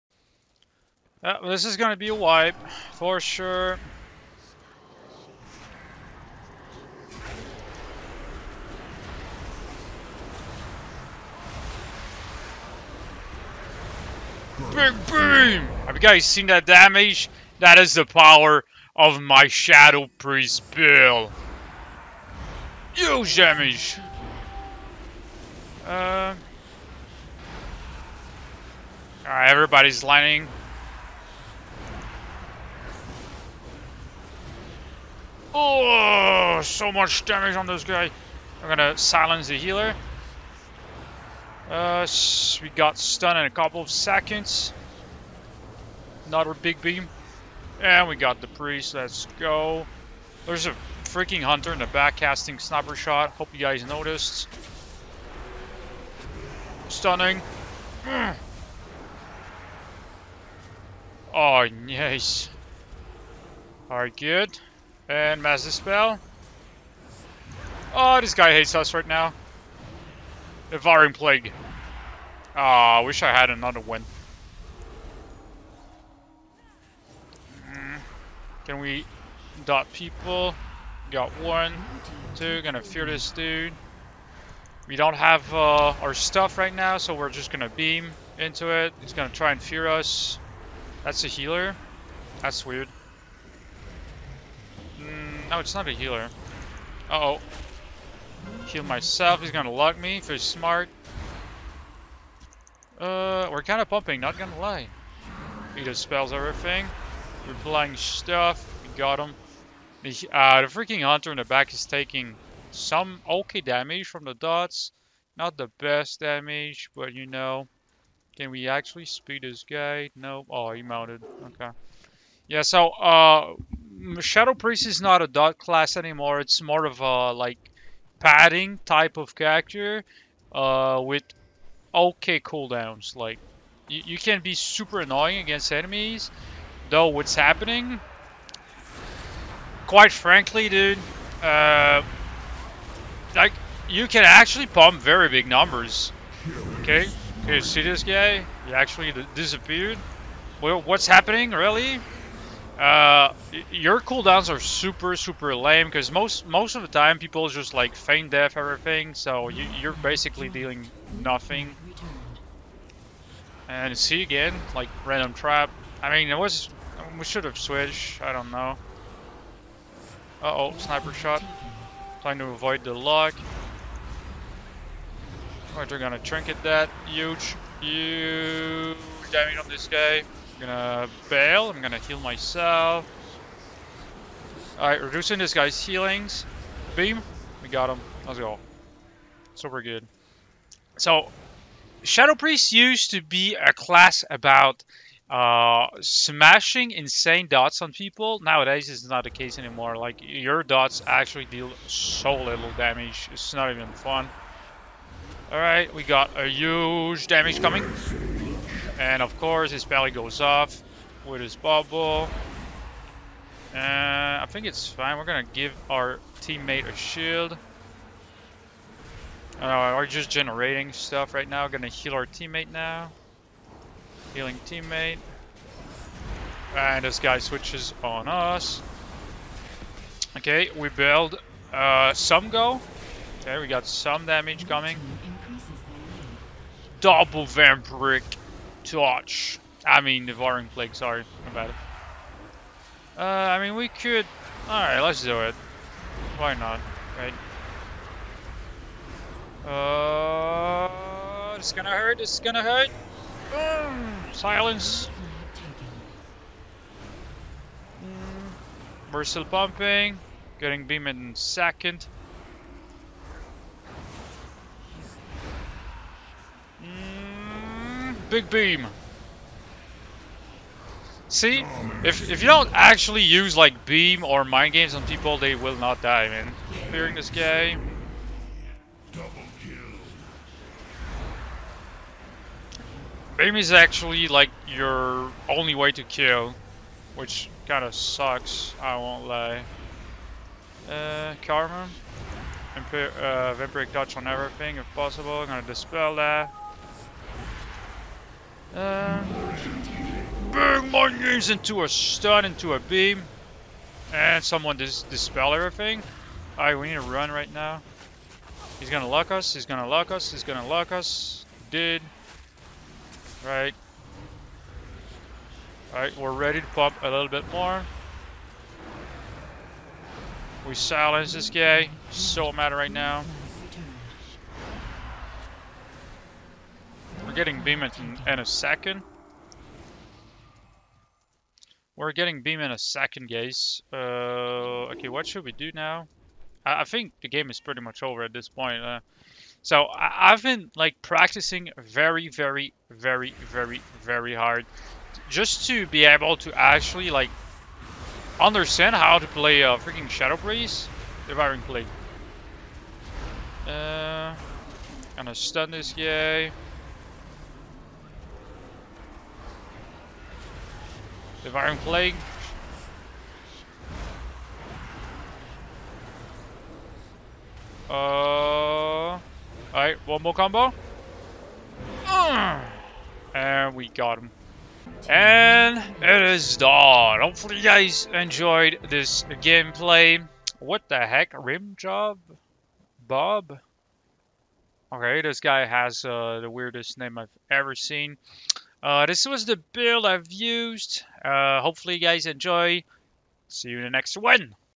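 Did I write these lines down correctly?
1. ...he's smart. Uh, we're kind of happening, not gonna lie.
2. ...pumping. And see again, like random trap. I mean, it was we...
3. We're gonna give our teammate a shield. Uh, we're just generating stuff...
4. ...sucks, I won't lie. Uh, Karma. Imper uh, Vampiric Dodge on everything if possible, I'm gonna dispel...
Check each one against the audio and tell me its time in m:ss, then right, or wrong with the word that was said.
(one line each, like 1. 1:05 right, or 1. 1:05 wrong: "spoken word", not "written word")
1. 1:40 wrong: "pumping", not "happening"
2. 2:41 wrong: "nothing", not "pumping"
3. 3:35 right
4. 4:47 right.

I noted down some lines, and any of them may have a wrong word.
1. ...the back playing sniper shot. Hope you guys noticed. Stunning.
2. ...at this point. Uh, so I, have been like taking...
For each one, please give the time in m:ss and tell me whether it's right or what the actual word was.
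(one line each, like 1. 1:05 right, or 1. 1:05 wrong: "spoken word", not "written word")
1. 0:51 wrong: "casting", not "playing"
2. 5:38 wrong: "practicing", not "taking".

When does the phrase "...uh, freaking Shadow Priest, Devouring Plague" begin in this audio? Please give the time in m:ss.
5:49.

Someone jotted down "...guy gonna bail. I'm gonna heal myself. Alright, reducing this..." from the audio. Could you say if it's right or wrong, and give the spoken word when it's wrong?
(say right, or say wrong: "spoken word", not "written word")
right.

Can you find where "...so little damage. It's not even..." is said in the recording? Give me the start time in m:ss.
3:21.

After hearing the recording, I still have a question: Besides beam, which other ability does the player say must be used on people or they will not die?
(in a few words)
Mind Games.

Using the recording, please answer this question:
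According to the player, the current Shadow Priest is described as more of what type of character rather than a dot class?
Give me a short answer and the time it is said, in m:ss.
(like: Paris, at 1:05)
padding type, at 2:08.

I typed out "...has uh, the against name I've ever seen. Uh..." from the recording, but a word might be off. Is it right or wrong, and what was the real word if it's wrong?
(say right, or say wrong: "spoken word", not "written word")
wrong: "weirdest", not "against".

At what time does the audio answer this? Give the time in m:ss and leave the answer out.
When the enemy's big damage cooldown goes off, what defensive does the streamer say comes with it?
3:31.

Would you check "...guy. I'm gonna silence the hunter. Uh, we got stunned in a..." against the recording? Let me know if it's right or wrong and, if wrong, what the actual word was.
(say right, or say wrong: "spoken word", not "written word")
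wrong: "healer", not "hunter".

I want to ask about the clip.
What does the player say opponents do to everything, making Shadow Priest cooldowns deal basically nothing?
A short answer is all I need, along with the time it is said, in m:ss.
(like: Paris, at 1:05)
Feign Death, at 2:37.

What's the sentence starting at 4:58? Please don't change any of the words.
Uh, bang my knees into a stun, into a beam.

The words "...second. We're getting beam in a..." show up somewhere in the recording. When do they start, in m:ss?
5:28.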